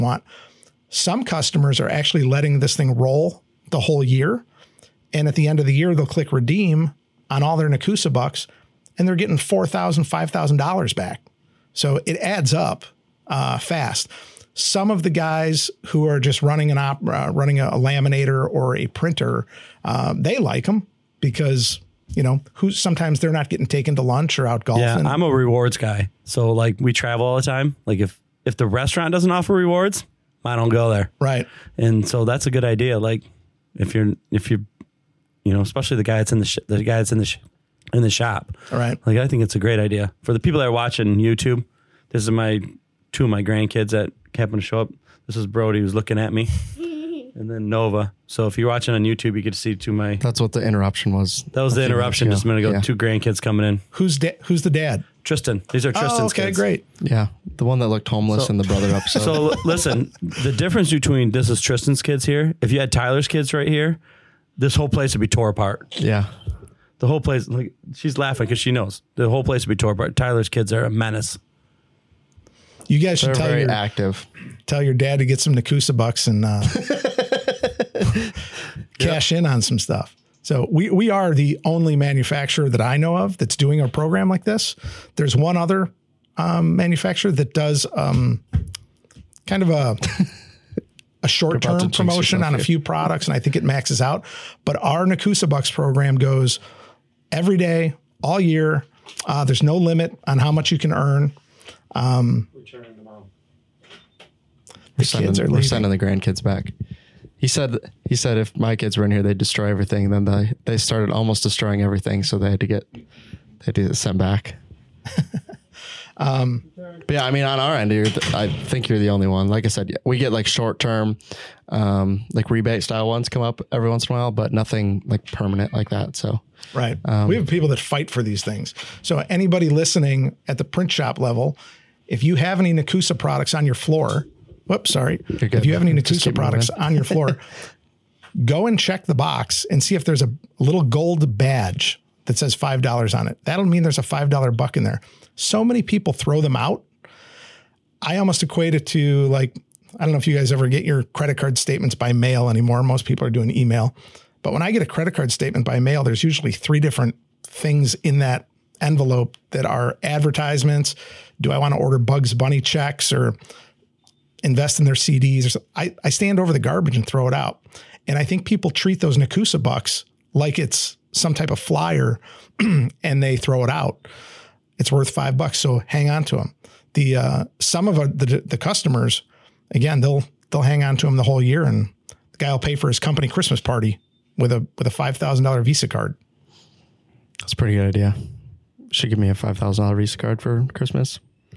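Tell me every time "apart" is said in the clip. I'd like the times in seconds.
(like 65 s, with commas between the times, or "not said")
65 s, 69 s.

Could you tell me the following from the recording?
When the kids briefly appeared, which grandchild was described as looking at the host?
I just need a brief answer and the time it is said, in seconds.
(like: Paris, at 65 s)
Brody, at 45 s.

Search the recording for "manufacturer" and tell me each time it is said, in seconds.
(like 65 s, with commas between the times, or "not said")
81 s, 86 s.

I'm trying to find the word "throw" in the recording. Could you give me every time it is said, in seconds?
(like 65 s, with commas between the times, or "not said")
146 s, 167 s, 173 s.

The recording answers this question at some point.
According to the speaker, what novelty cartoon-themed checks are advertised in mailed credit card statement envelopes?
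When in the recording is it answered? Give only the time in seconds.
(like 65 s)
161 s.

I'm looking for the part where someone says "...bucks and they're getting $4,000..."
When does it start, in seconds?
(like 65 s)
8 s.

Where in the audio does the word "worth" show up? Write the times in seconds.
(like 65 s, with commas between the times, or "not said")
174 s.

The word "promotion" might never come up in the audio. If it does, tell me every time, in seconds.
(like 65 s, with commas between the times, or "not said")
91 s.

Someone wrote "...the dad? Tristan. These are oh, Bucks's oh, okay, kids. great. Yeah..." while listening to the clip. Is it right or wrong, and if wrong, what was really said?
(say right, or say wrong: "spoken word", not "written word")
wrong: "Tristan", not "Bucks".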